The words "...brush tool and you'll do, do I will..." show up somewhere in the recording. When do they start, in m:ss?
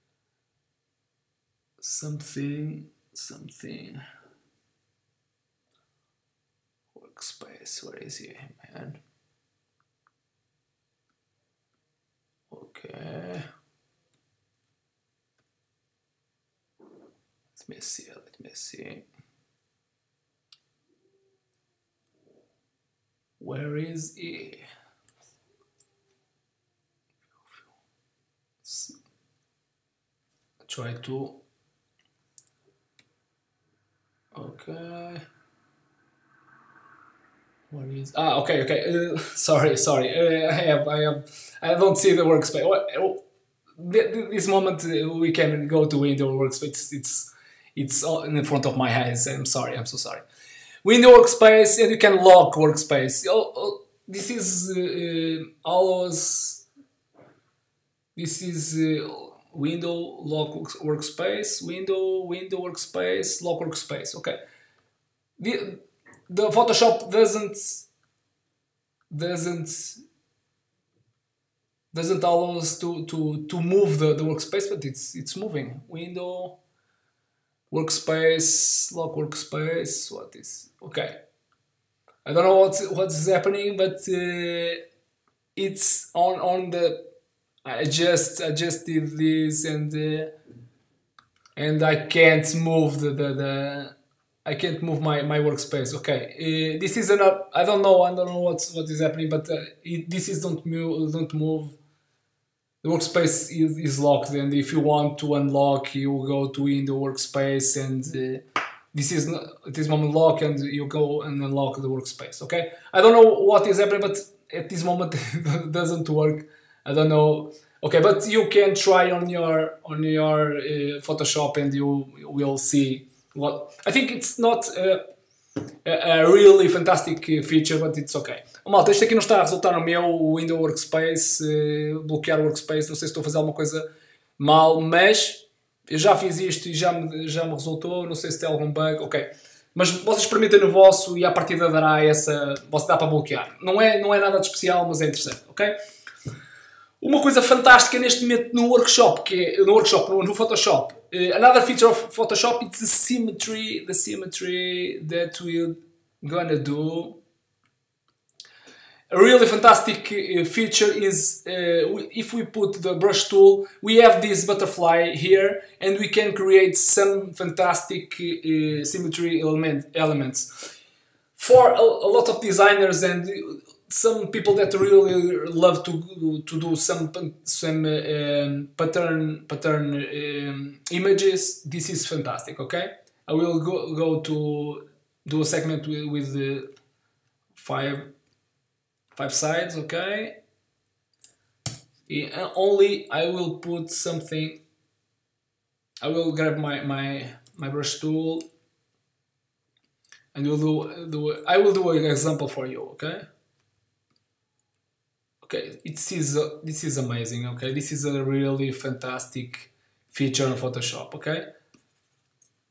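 3:17.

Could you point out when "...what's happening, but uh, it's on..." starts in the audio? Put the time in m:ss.
1:22.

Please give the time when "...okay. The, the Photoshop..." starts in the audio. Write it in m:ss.
1:04.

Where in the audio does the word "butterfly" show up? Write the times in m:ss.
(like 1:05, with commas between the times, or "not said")
2:44.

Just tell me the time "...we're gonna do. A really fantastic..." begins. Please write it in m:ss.
2:35.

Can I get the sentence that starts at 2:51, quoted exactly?
For a, a lot of designers and some people that really love to to do some some um, pattern pattern um, images.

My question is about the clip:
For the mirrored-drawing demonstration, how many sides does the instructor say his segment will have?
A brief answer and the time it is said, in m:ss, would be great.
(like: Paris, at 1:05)
5, at 3:07.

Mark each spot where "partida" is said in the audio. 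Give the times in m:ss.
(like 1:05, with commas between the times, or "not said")
2:21.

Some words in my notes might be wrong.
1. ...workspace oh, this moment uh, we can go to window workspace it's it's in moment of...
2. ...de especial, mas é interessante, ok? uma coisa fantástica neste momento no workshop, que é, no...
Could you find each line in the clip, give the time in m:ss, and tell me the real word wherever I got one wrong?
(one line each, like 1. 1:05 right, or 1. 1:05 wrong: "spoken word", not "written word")
1. 0:42 wrong: "front", not "moment"
2. 2:24 right.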